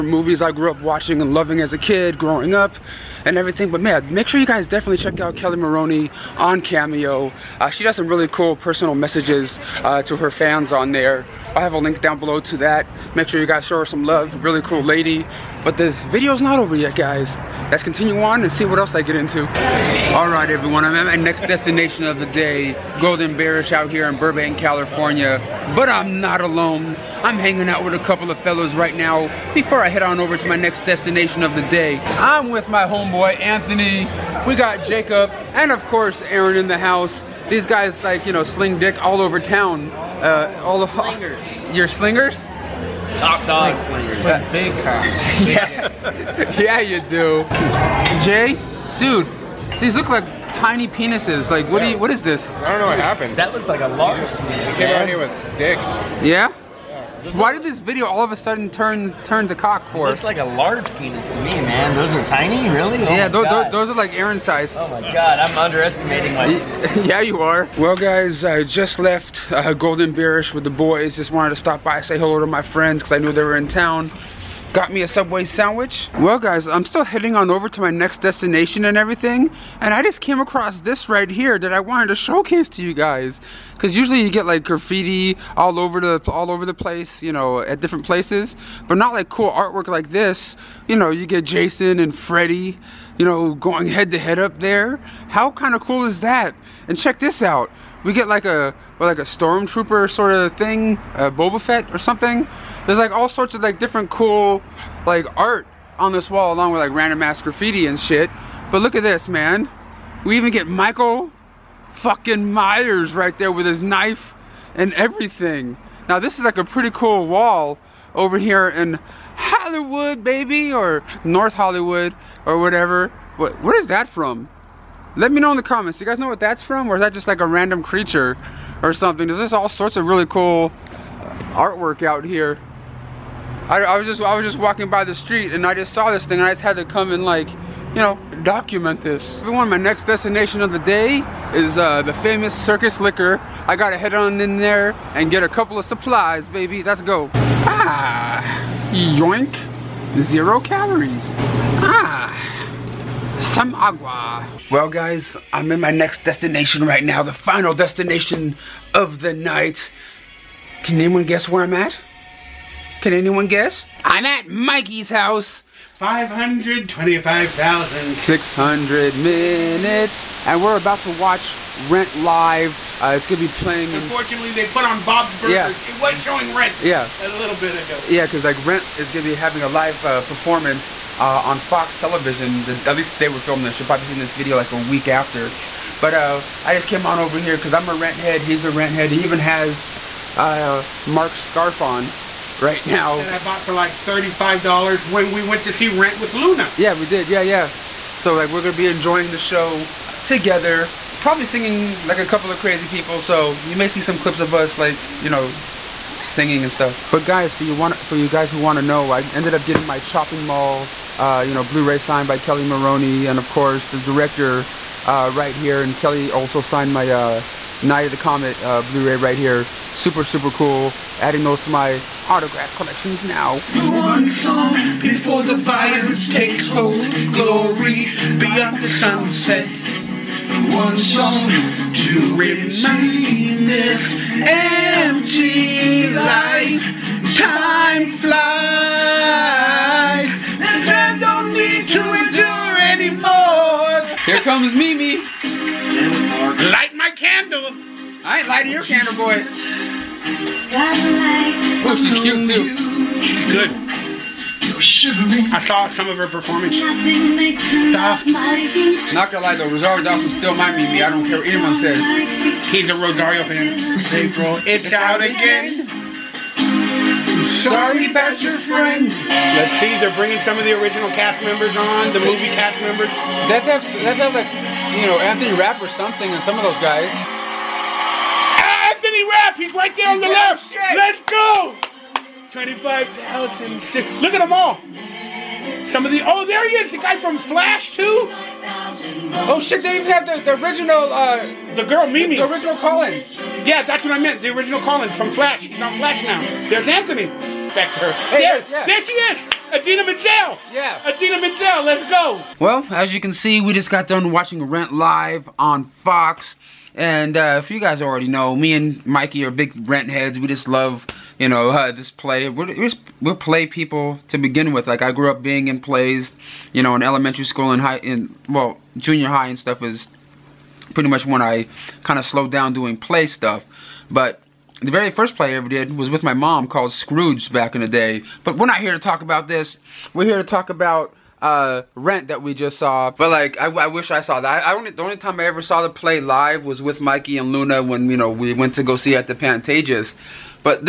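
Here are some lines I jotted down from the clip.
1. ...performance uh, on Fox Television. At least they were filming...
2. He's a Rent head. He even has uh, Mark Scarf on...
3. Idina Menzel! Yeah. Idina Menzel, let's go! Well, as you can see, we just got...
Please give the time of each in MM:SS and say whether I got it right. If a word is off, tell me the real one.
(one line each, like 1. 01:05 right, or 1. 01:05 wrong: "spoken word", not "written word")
1. 03:00 right
2. 03:08 right
3. 04:59 right.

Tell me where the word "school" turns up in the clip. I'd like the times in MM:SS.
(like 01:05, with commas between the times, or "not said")
05:17.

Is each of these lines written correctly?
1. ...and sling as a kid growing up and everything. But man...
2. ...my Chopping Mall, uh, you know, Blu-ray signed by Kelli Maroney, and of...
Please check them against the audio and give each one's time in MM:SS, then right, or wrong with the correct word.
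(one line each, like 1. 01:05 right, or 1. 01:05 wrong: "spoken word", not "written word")
1. 00:01 wrong: "loving", not "sling"
2. 03:29 right.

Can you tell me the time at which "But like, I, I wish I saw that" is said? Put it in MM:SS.
05:33.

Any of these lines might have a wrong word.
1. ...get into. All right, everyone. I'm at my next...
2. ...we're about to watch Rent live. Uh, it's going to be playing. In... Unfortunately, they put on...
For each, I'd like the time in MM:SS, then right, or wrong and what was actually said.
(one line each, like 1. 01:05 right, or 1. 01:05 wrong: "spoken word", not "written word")
1. 00:19 right
2. 02:50 right.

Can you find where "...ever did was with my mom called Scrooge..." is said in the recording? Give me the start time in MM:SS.
05:25.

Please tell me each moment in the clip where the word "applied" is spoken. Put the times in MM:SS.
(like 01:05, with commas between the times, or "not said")
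not said.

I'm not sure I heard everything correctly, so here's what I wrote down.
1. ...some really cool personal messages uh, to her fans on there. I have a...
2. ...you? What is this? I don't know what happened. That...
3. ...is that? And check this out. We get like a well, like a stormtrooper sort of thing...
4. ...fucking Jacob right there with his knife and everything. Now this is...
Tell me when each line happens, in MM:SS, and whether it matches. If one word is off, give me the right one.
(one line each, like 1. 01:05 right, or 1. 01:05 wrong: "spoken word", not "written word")
1. 00:07 right
2. 00:51 right
3. 01:36 right
4. 01:51 wrong: "Myers", not "Jacob".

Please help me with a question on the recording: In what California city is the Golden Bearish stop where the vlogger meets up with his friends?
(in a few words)
Burbank.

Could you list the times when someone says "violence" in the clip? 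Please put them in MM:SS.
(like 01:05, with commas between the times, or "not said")
03:45.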